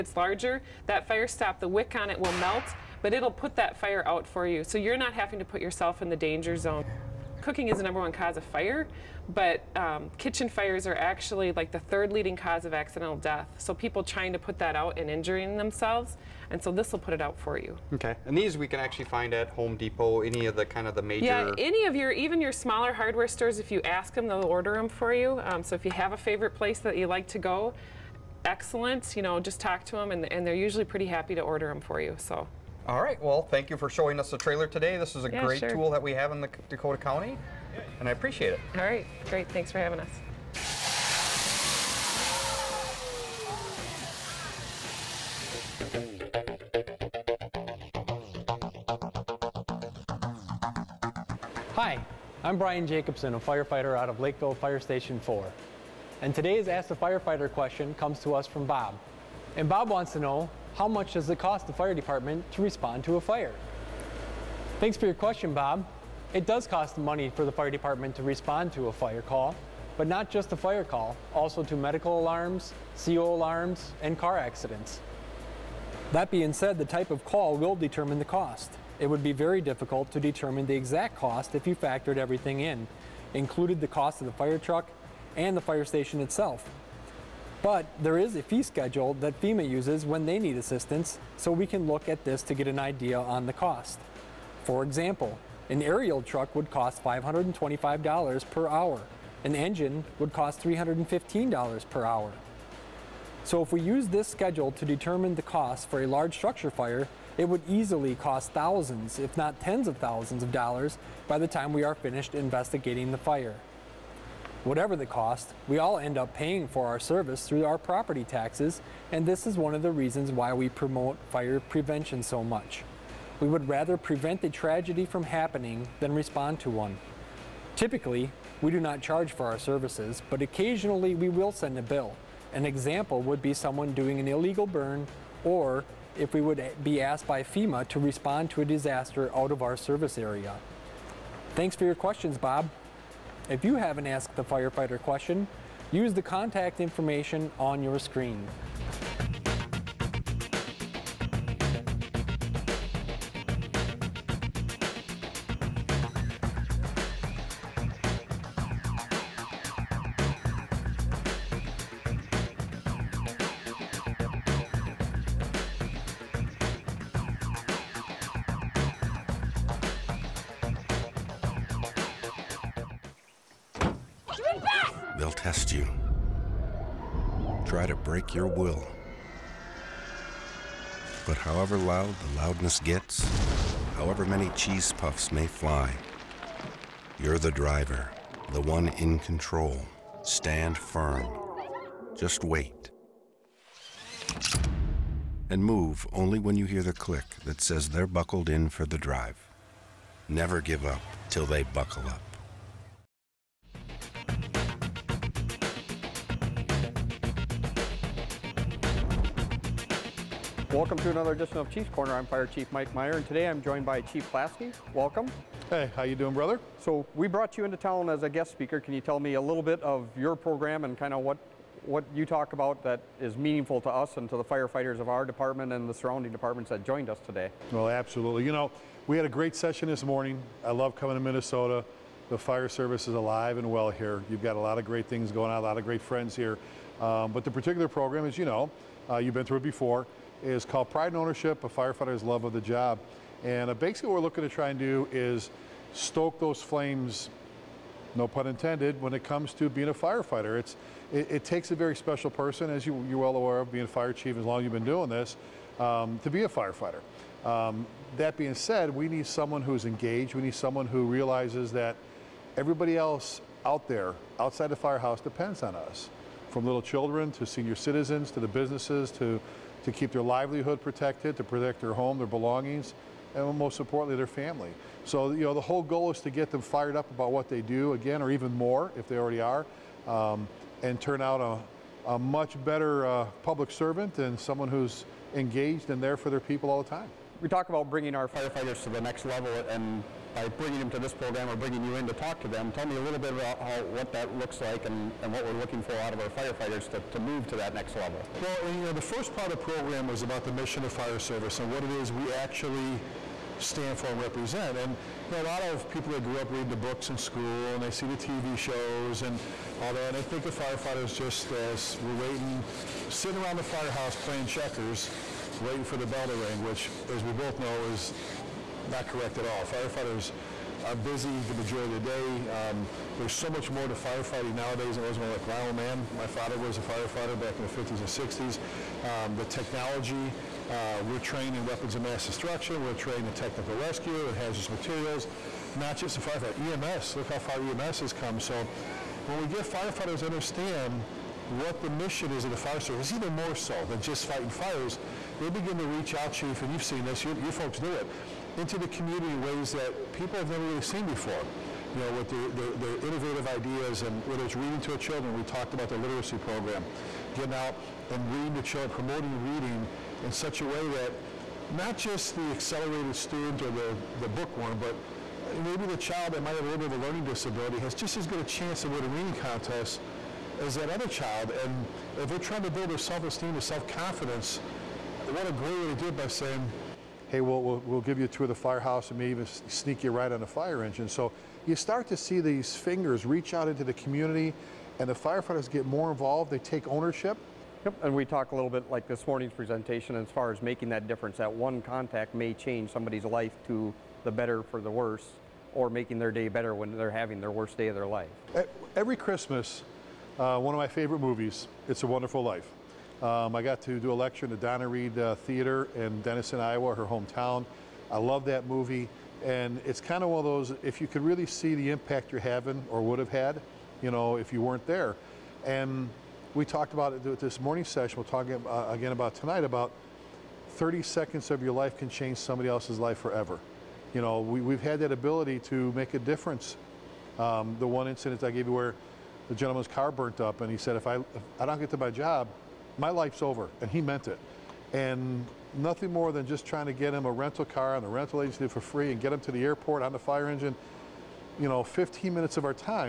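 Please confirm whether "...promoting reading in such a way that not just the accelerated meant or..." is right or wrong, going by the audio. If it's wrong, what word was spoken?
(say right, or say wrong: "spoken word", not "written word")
wrong: "student", not "meant".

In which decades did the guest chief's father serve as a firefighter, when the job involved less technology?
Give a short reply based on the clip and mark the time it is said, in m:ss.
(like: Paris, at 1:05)
50s and 60s, at 5:27.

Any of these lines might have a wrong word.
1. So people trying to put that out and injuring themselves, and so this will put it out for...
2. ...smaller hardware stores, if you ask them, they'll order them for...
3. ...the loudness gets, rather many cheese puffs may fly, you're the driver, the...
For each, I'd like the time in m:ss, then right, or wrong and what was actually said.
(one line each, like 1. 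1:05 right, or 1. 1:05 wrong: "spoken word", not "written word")
1. 0:13 right
2. 0:22 right
3. 3:02 wrong: "however", not "rather".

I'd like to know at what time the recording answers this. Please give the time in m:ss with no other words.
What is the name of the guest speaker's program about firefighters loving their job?
4:00.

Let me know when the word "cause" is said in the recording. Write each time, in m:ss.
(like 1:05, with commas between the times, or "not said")
0:08, 0:12.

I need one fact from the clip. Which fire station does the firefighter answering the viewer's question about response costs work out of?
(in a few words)
Lakeville Fire Station 4.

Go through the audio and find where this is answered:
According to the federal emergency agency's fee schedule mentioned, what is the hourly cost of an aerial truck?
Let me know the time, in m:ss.
1:37.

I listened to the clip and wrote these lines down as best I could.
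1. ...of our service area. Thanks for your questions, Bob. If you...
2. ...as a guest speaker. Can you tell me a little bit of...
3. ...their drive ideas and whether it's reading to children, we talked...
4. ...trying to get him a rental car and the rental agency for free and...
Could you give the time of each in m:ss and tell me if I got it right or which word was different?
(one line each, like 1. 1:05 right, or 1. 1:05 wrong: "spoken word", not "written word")
1. 2:19 right
2. 3:38 right
3. 5:52 wrong: "innovative", not "drive"
4. 7:16 right.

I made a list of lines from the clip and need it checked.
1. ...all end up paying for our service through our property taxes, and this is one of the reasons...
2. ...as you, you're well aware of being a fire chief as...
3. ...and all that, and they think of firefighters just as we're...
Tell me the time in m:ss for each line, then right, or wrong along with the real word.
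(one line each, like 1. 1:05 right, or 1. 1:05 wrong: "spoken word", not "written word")
1. 1:55 right
2. 4:12 right
3. 5:09 right.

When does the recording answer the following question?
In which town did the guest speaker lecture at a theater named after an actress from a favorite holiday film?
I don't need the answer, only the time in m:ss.
6:46.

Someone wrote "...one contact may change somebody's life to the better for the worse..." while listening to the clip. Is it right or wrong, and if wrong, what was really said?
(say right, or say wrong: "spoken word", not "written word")
right.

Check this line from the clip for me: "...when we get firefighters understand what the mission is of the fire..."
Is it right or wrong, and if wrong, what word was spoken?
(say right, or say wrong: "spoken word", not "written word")
right.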